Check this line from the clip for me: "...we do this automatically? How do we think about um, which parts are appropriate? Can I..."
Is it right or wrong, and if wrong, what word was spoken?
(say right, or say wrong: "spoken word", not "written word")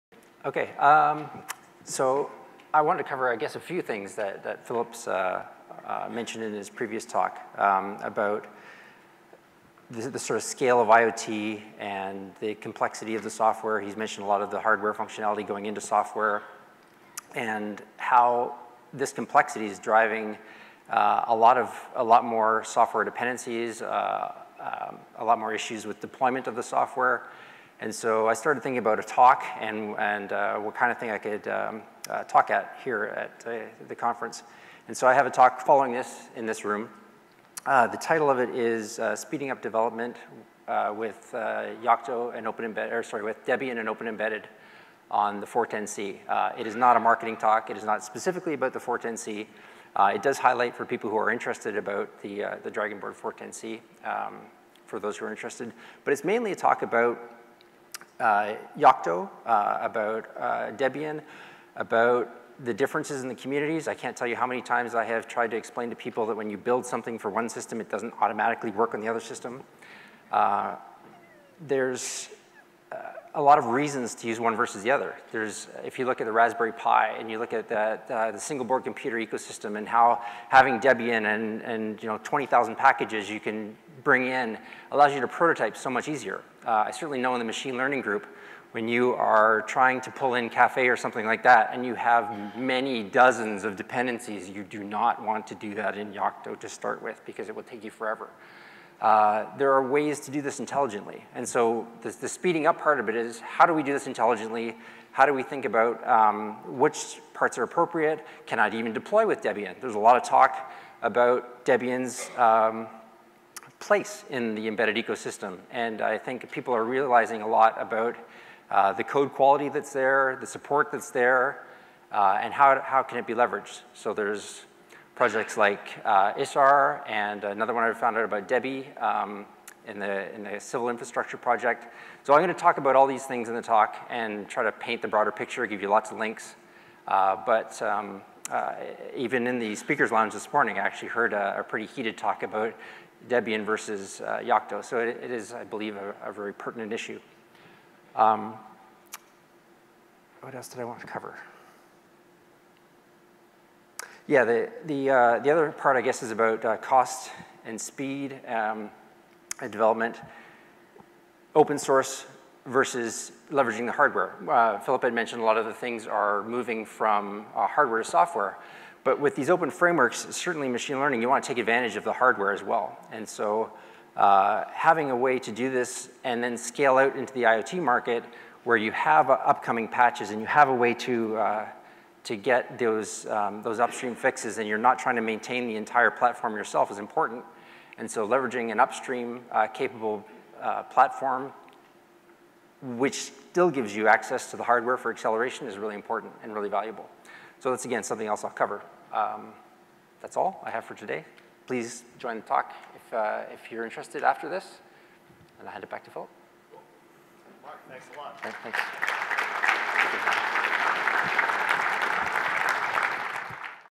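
wrong: "intelligently", not "automatically".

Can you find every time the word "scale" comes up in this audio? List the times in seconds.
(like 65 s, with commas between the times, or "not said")
10 s, 176 s.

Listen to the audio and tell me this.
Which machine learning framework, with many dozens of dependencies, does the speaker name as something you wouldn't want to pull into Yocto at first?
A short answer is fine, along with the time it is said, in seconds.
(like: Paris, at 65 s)
Caffe, at 90 s.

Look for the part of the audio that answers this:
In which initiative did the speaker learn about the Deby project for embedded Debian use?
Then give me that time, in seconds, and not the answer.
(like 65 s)
130 s.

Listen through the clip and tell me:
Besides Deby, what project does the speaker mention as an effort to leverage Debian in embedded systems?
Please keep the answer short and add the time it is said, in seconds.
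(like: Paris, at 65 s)
ISAR, at 126 s.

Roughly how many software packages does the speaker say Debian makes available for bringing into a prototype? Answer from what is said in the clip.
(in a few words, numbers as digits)
20,000.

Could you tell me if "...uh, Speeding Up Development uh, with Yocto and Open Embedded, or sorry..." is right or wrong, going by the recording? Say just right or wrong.
right.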